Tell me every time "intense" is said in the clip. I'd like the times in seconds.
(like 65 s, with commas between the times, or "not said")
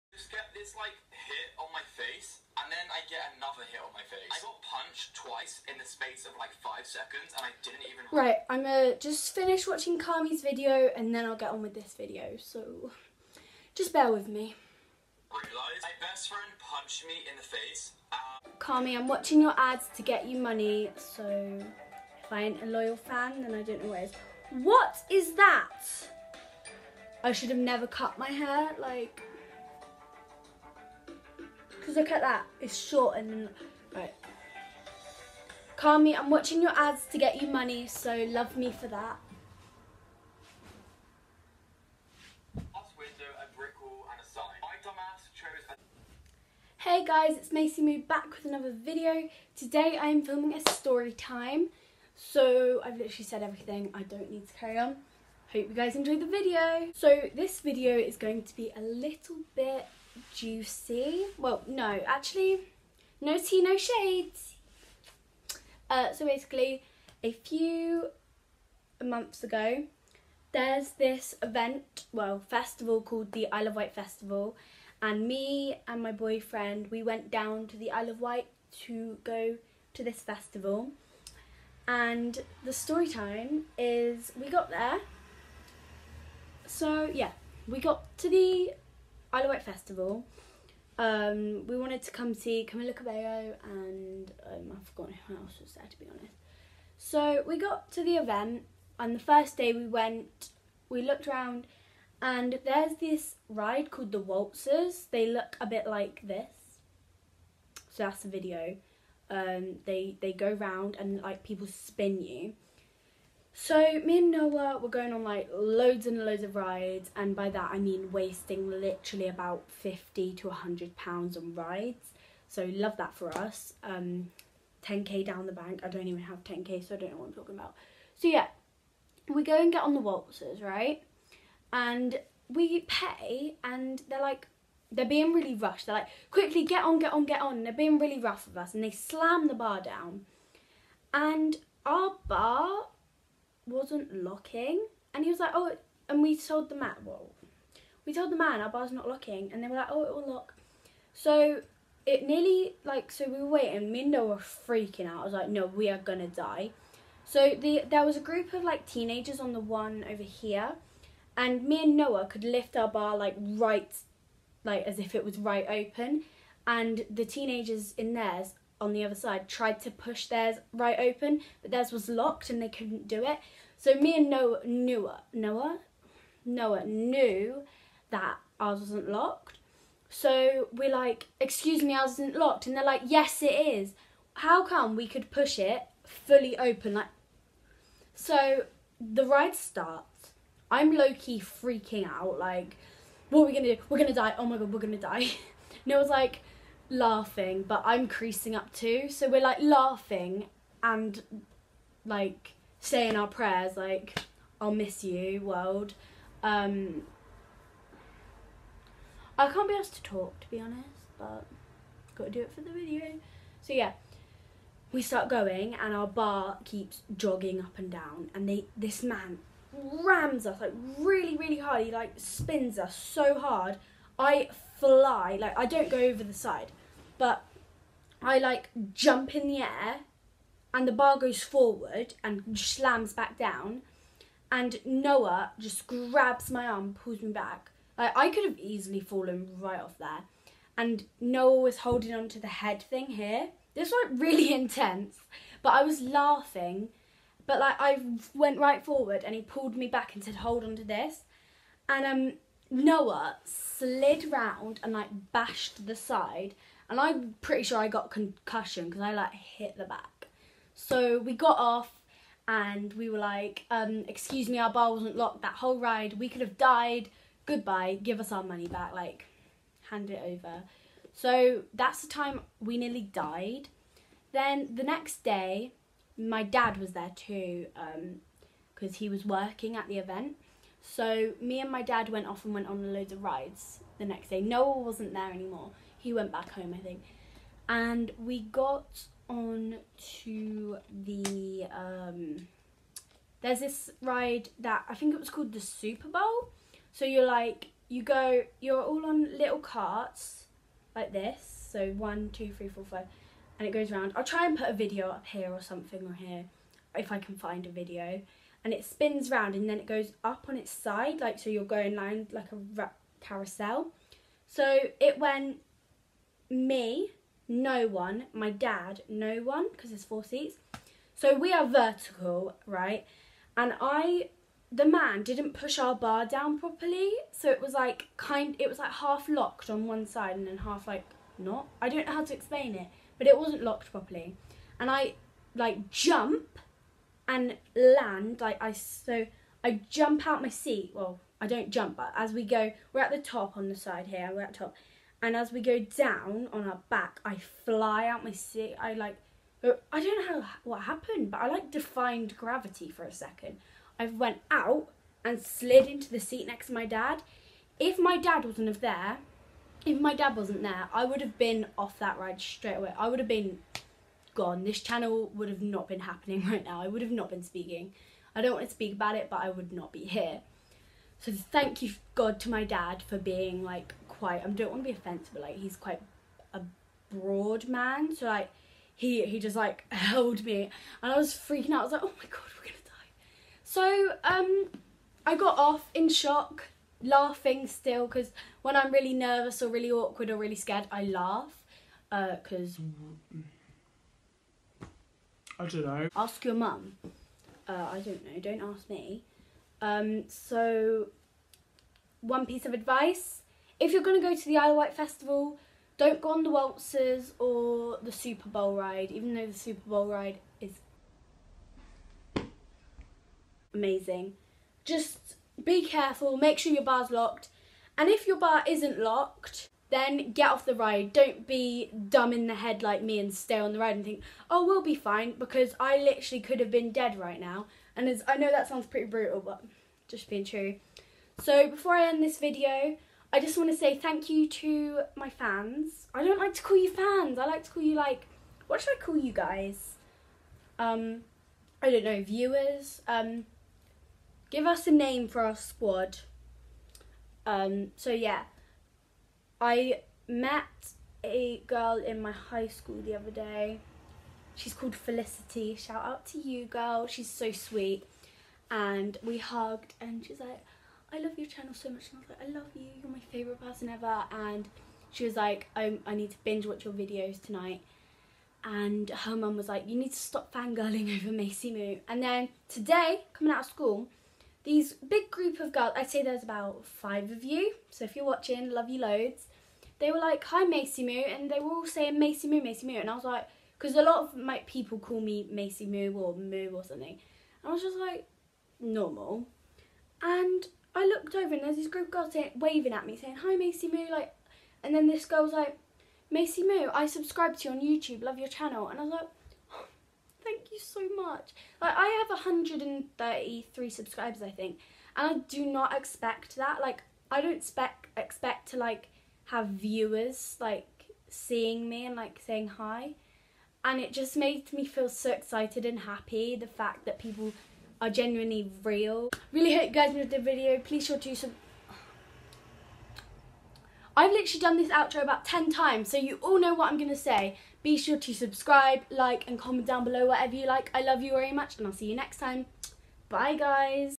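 244 s.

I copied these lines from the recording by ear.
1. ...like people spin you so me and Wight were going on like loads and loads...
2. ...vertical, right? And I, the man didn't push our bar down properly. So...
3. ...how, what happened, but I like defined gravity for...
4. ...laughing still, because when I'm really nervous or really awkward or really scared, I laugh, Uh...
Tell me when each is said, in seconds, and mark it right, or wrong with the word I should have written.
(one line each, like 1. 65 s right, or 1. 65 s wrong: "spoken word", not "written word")
1. 111 s wrong: "Noah", not "Wight"
2. 321 s right
3. 350 s right
4. 387 s right.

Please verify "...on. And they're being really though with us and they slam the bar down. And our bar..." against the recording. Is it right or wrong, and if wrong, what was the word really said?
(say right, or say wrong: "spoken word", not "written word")
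wrong: "rough", not "though".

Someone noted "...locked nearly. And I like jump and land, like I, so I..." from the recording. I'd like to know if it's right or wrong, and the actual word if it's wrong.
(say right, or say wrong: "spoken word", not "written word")
wrong: "properly", not "nearly".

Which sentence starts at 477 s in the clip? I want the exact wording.
So if you're watching, love you loads.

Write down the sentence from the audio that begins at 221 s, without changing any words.
He like spins us so hard.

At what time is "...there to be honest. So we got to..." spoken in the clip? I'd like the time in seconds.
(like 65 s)
95 s.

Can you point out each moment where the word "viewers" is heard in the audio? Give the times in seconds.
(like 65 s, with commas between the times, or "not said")
442 s, 509 s.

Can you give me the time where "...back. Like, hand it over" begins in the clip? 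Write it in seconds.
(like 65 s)
268 s.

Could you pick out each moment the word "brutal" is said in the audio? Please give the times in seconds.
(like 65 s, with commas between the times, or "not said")
429 s.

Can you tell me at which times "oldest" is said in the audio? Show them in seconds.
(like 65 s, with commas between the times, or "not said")
not said.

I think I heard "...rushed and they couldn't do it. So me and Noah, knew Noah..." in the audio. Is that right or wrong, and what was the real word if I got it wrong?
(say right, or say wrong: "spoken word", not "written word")
wrong: "locked", not "rushed".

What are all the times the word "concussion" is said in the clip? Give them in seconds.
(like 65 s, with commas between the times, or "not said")
258 s.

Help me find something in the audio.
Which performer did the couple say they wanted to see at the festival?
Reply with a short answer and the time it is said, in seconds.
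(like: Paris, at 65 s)
Camila Cabello, at 92 s.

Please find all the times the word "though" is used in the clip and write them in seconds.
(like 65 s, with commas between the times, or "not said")
409 s.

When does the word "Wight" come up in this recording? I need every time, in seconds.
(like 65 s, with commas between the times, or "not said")
73 s, 78 s, 89 s, 404 s.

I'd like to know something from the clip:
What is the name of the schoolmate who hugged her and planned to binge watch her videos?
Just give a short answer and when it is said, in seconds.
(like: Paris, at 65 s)
Felicity, at 454 s.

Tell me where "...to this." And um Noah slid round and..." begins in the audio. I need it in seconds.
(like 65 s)
250 s.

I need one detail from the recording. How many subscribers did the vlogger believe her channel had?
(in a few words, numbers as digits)
133.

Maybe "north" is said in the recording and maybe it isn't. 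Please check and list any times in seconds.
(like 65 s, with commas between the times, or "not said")
not said.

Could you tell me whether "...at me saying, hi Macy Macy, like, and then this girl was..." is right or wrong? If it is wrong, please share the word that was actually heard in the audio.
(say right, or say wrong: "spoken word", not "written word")
wrong: "Moo", not "Macy".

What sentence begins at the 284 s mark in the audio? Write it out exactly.
Noah wasn't there anymore he went back home, I think.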